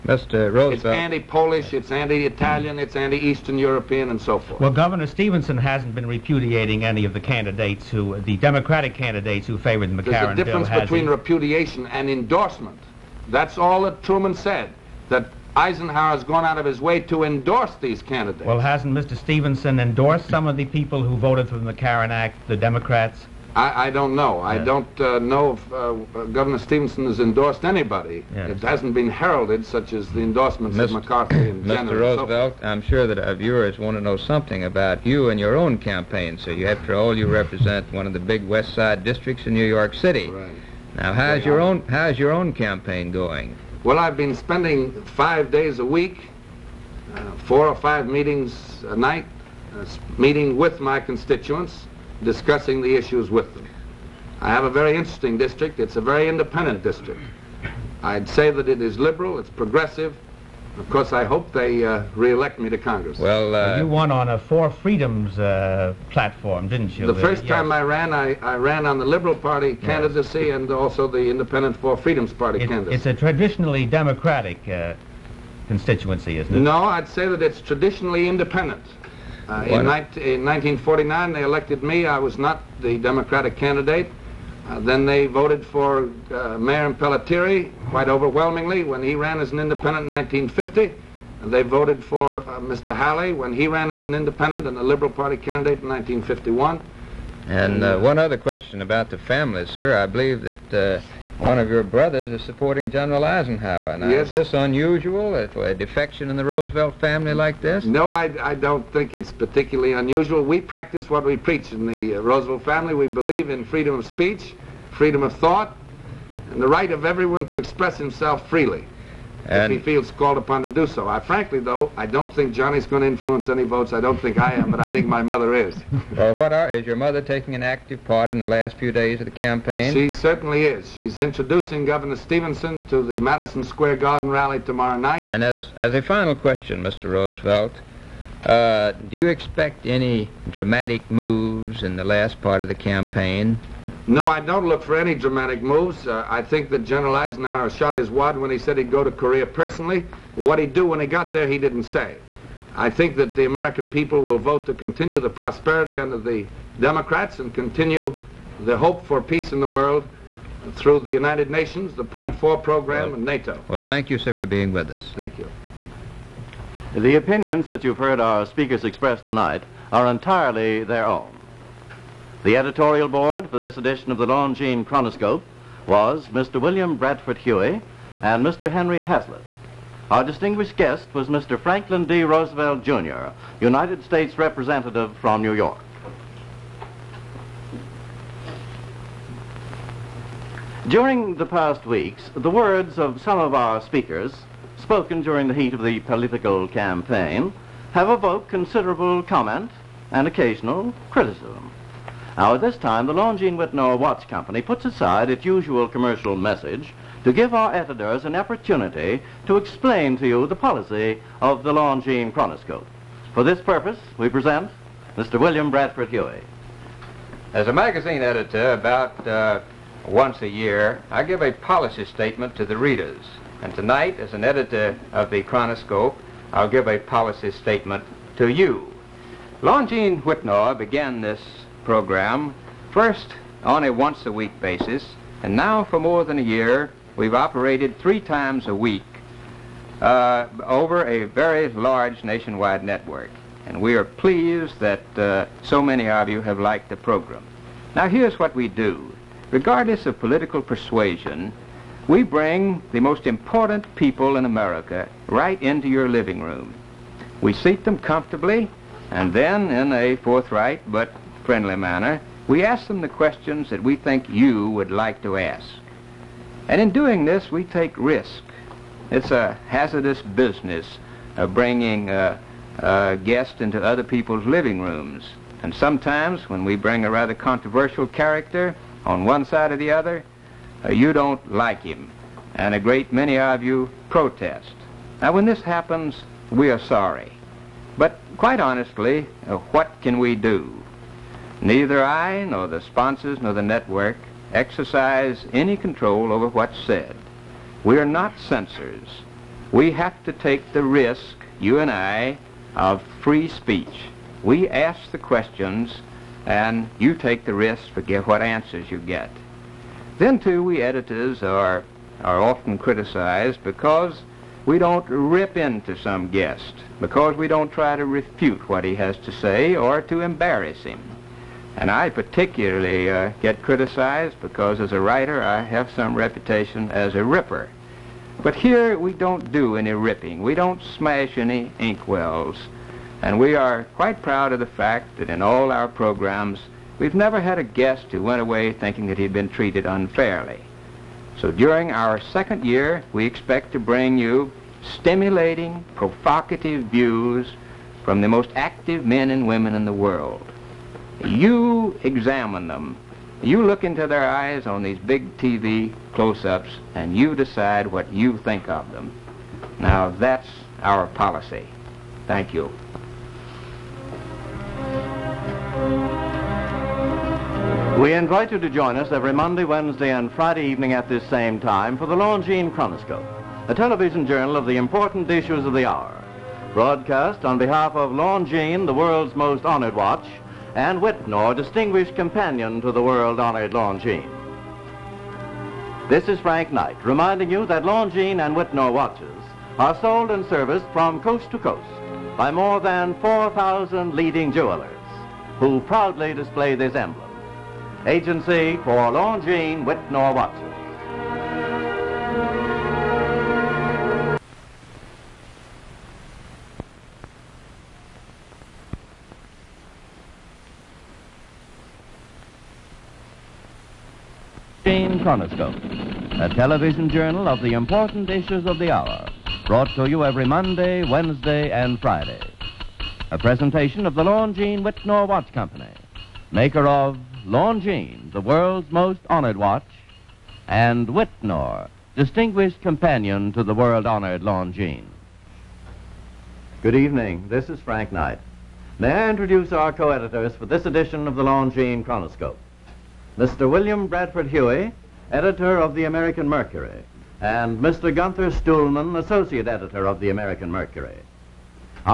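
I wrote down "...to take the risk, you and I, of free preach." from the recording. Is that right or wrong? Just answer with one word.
wrong.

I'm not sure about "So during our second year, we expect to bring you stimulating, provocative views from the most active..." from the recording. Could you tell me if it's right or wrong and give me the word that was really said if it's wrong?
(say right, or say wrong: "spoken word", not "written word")
right.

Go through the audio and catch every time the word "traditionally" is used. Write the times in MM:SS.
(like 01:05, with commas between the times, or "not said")
01:13, 01:17.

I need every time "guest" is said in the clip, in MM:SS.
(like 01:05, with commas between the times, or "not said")
03:00, 04:33, 05:16, 05:37.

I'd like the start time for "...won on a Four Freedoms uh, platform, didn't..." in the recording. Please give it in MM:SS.
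01:03.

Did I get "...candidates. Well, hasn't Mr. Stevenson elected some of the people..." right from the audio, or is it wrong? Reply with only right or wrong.
wrong.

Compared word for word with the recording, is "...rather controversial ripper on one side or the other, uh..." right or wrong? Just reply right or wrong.
wrong.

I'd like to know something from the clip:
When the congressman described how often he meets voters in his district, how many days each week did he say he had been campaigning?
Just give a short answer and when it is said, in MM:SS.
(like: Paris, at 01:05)
5, at 00:45.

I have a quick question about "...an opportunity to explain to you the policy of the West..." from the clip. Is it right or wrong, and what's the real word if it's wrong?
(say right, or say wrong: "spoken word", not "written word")
wrong: "Longine", not "West".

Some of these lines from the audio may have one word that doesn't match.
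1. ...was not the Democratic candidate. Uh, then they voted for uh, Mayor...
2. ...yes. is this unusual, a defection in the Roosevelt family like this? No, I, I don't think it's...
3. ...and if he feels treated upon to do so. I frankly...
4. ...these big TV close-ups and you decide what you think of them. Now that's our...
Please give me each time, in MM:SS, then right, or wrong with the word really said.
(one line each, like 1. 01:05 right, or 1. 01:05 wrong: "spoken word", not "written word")
1. 01:22 right
2. 01:44 right
3. 01:59 wrong: "called", not "treated"
4. 05:54 right.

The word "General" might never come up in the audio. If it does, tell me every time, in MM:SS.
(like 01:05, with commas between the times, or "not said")
00:31, 01:42, 02:26.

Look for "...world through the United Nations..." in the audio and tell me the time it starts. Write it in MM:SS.
02:39.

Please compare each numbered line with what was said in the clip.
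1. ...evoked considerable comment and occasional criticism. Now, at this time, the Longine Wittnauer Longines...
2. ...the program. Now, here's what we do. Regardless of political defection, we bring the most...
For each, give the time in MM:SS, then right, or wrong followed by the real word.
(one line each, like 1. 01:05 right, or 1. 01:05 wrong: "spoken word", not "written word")
1. 03:18 wrong: "Watts", not "Longines"
2. 04:06 wrong: "persuasion", not "defection".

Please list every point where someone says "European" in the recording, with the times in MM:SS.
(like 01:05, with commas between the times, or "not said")
00:03.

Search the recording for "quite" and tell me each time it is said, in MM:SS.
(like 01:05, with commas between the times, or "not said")
01:27, 04:48, 05:33.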